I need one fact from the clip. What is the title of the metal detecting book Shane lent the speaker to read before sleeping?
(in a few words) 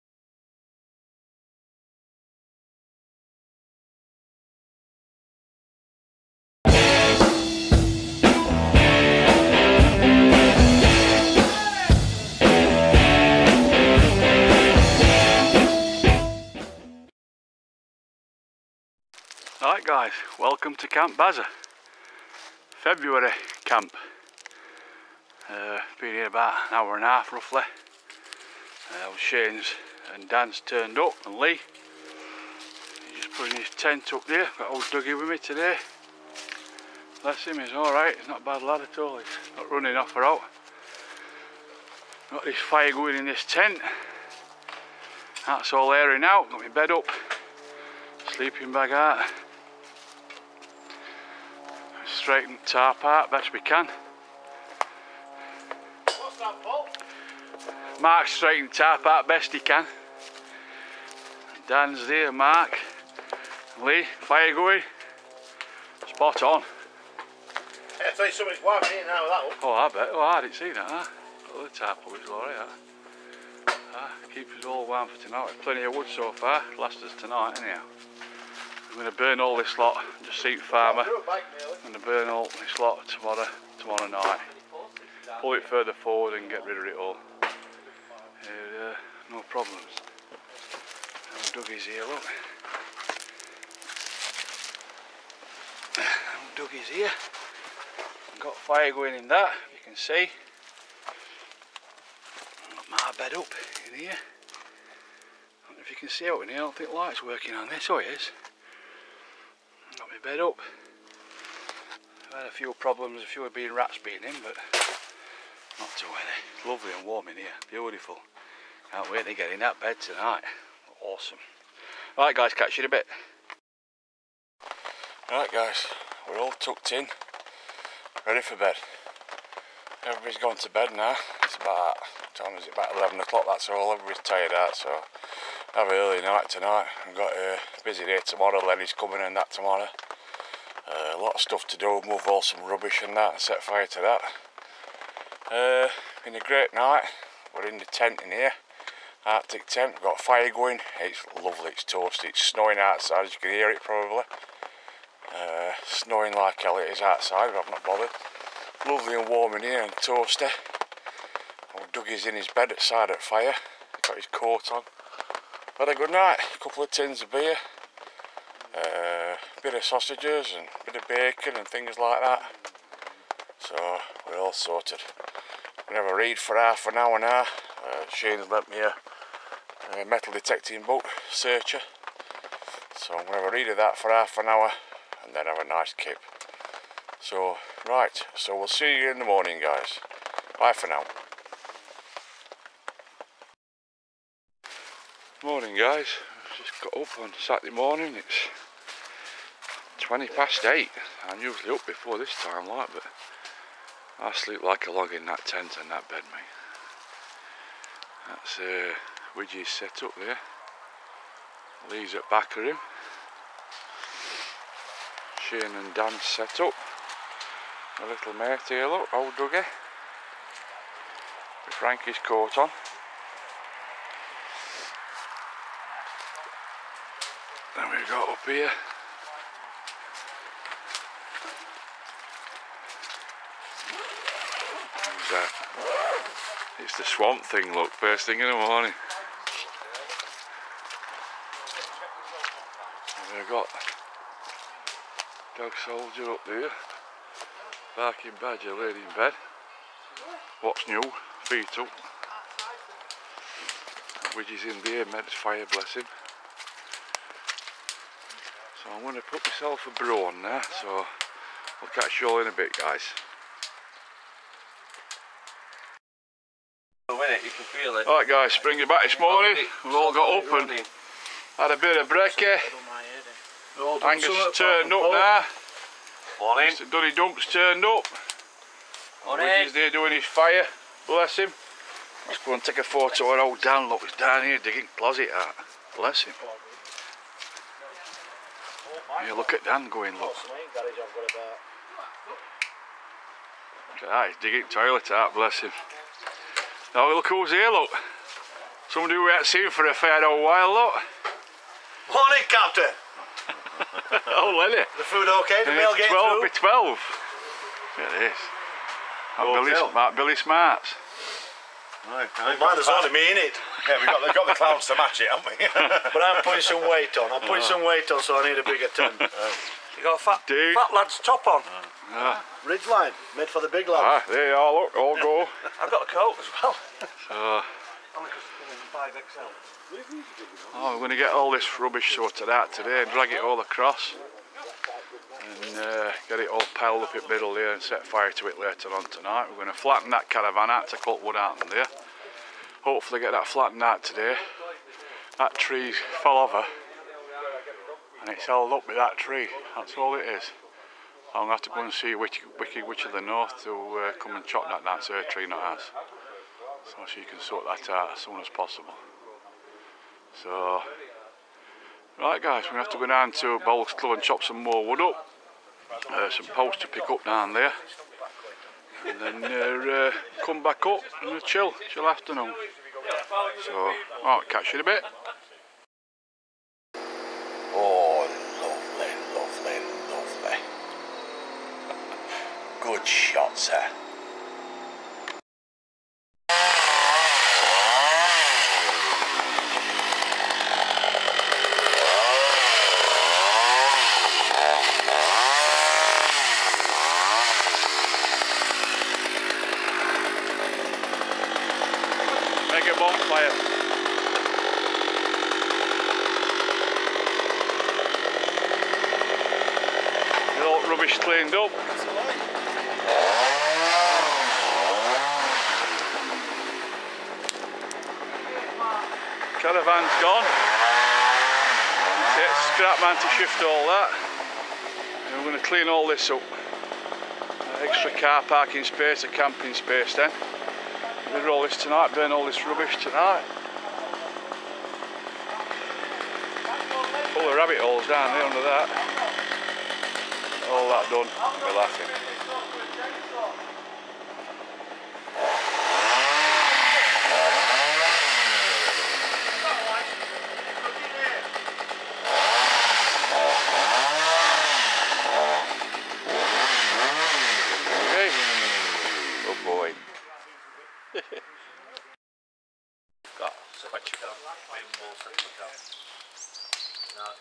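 Searcher.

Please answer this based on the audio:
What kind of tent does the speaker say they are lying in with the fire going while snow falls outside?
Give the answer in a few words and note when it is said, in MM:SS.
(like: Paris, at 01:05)
Arctic tent, at 02:29.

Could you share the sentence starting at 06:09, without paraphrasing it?
And then uh, uh come back up and chill, chill afternoon.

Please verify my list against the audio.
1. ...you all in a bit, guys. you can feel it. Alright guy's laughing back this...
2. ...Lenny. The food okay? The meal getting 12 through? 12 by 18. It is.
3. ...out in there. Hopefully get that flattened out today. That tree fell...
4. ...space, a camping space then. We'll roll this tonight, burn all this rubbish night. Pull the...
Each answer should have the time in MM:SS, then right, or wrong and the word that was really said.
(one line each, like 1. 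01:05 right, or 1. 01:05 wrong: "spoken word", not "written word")
1. 04:22 wrong: "springing", not "laughing"
2. 05:04 wrong: "12", not "18"
3. 05:41 right
4. 07:08 wrong: "tonight", not "night".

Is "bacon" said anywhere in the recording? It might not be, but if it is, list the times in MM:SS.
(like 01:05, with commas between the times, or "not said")
02:51.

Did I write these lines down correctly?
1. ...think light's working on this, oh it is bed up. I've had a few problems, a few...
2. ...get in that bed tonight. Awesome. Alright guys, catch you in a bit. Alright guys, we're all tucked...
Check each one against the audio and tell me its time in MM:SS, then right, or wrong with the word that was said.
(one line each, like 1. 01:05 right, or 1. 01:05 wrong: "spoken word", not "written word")
1. 01:46 right
2. 01:59 right.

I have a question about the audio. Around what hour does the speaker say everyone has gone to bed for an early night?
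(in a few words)
11 o'clock.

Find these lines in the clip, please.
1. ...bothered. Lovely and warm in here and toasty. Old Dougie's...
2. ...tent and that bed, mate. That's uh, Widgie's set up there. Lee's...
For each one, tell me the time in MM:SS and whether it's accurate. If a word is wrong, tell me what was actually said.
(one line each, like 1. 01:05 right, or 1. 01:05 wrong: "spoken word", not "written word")
1. 02:37 right
2. 03:25 right.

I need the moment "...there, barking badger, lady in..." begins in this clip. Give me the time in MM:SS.
04:06.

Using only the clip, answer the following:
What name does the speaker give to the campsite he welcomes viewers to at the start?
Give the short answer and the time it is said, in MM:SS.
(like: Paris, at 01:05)
Camp Bazza, at 00:20.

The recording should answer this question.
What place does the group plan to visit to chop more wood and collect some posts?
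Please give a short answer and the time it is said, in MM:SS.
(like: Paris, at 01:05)
Bowles Club, at 06:03.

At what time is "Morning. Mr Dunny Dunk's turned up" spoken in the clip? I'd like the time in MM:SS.
04:36.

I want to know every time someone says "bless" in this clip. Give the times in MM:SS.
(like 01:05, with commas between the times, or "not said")
00:37, 04:15, 04:41, 04:45, 04:55.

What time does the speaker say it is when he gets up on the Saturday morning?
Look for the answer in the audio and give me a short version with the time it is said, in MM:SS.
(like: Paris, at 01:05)
8:20, at 03:20.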